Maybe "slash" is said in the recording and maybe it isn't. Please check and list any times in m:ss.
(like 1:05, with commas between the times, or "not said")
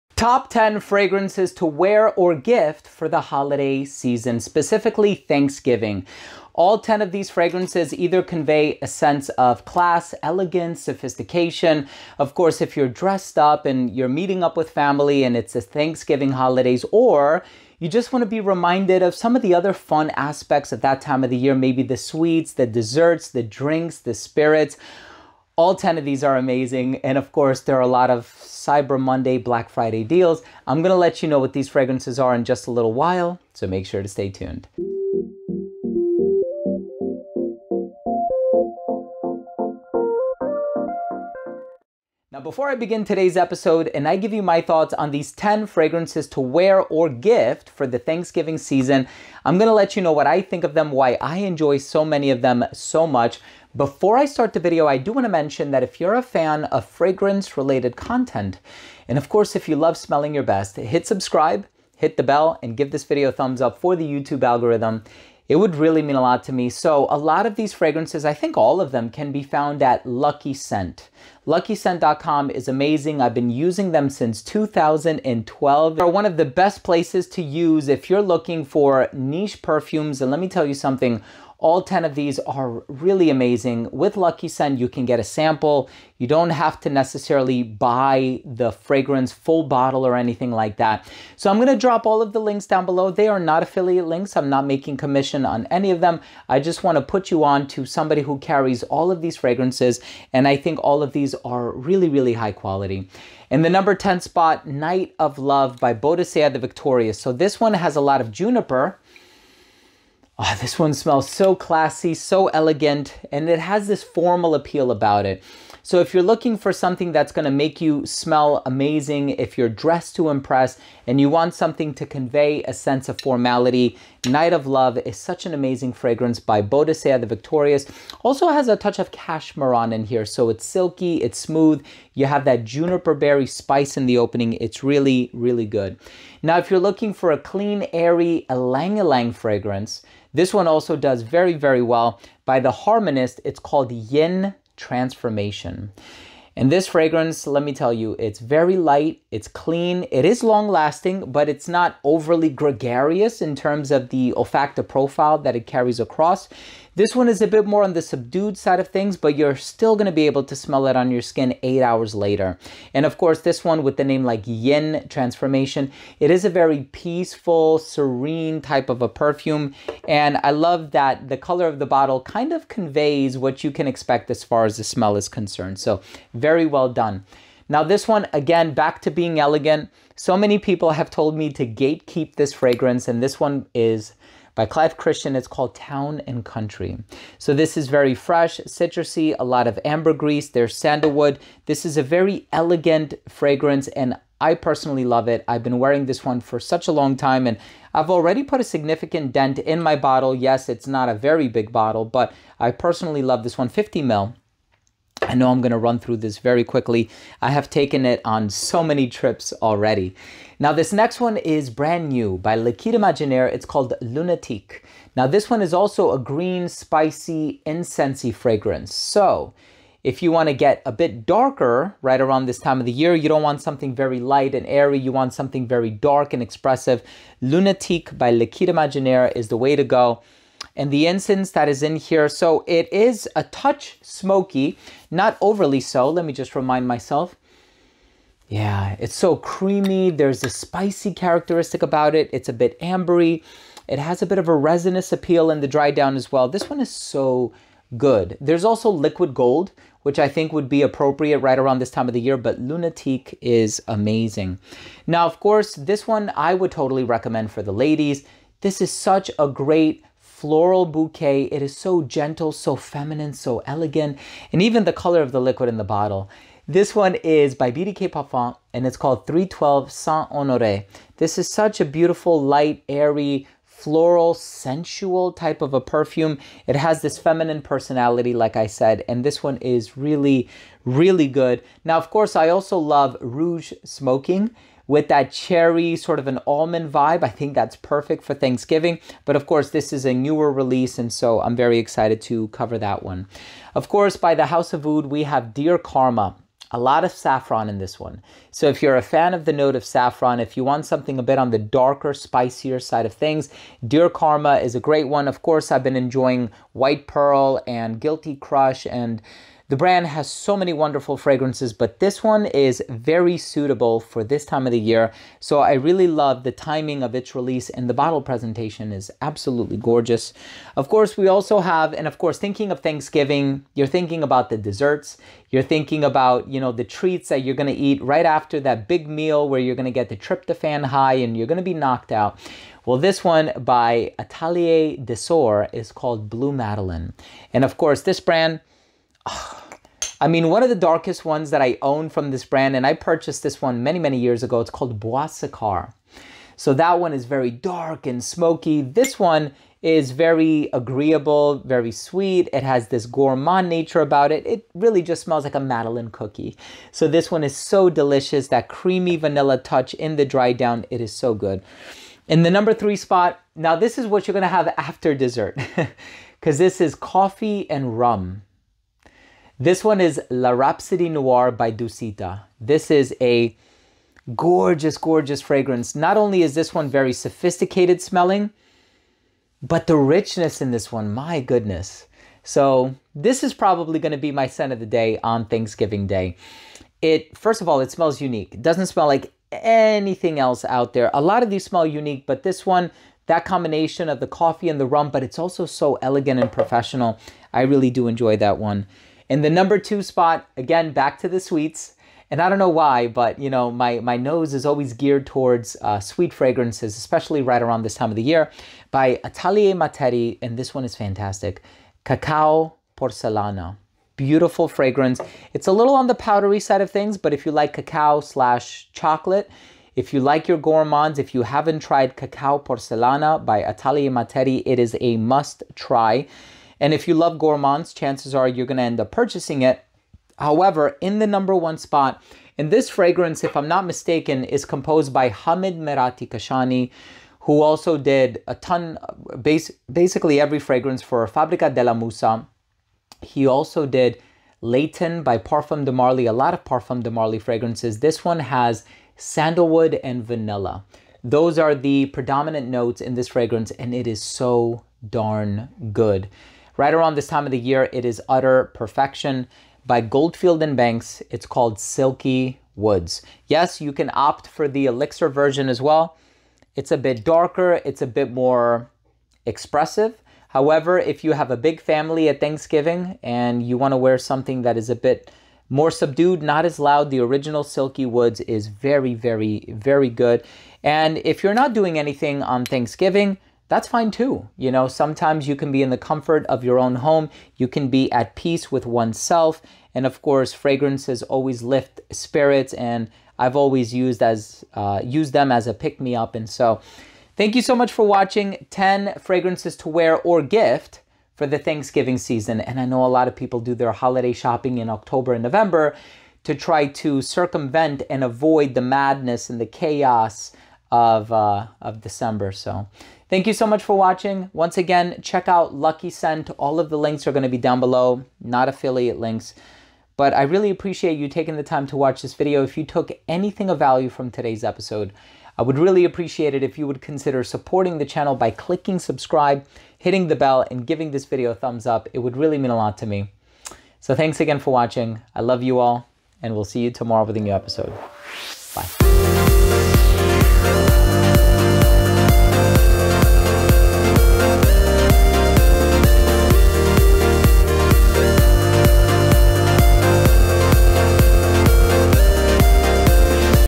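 6:58.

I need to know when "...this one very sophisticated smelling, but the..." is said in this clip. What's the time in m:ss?
6:16.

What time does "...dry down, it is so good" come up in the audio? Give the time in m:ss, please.
6:00.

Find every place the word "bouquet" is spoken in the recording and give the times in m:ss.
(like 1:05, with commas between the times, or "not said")
4:20.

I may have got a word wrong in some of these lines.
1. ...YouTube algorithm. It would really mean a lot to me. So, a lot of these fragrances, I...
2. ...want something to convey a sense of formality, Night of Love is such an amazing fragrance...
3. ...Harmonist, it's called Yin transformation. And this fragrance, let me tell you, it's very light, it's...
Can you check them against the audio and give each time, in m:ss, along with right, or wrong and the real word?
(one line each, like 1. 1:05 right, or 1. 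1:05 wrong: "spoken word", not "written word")
1. 1:04 right
2. 2:01 right
3. 2:22 right.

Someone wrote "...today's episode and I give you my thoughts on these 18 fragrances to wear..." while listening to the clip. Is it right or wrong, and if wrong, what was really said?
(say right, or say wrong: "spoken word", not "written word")
wrong: "10", not "18".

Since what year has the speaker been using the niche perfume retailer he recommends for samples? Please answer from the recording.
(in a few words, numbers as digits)
2012.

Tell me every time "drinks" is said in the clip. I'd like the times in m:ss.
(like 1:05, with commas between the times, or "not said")
0:23.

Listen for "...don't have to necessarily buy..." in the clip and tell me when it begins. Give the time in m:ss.
1:26.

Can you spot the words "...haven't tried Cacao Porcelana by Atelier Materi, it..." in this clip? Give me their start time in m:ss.
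7:01.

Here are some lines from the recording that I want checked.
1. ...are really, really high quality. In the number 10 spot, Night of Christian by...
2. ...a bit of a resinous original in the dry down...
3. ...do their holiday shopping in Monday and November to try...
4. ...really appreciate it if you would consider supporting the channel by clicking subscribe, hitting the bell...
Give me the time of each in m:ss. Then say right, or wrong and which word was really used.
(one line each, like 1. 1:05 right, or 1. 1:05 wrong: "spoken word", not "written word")
1. 1:41 wrong: "Love", not "Christian"
2. 4:04 wrong: "appeal", not "original"
3. 8:23 wrong: "October", not "Monday"
4. 8:45 right.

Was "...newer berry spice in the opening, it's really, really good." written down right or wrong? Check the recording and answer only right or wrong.
wrong.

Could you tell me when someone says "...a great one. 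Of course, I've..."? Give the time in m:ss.
5:04.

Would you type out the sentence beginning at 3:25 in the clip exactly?
I know I'm going to run through this very quickly.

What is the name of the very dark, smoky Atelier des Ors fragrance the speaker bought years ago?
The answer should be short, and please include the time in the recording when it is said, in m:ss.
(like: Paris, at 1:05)
Bois Sikar, at 5:44.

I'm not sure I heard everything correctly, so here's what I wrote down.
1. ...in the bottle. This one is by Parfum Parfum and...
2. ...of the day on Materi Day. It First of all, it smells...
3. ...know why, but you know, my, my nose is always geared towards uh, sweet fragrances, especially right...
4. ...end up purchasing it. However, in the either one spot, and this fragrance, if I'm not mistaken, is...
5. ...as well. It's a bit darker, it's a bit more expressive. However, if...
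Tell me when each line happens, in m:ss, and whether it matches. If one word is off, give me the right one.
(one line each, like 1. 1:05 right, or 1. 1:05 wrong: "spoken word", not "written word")
1. 4:25 wrong: "BDK", not "Parfum"
2. 6:24 wrong: "Thanksgiving", not "Materi"
3. 6:42 right
4. 7:08 wrong: "number", not "either"
5. 7:45 right.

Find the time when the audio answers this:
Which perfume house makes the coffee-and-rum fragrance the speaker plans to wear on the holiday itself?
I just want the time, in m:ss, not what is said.
6:11.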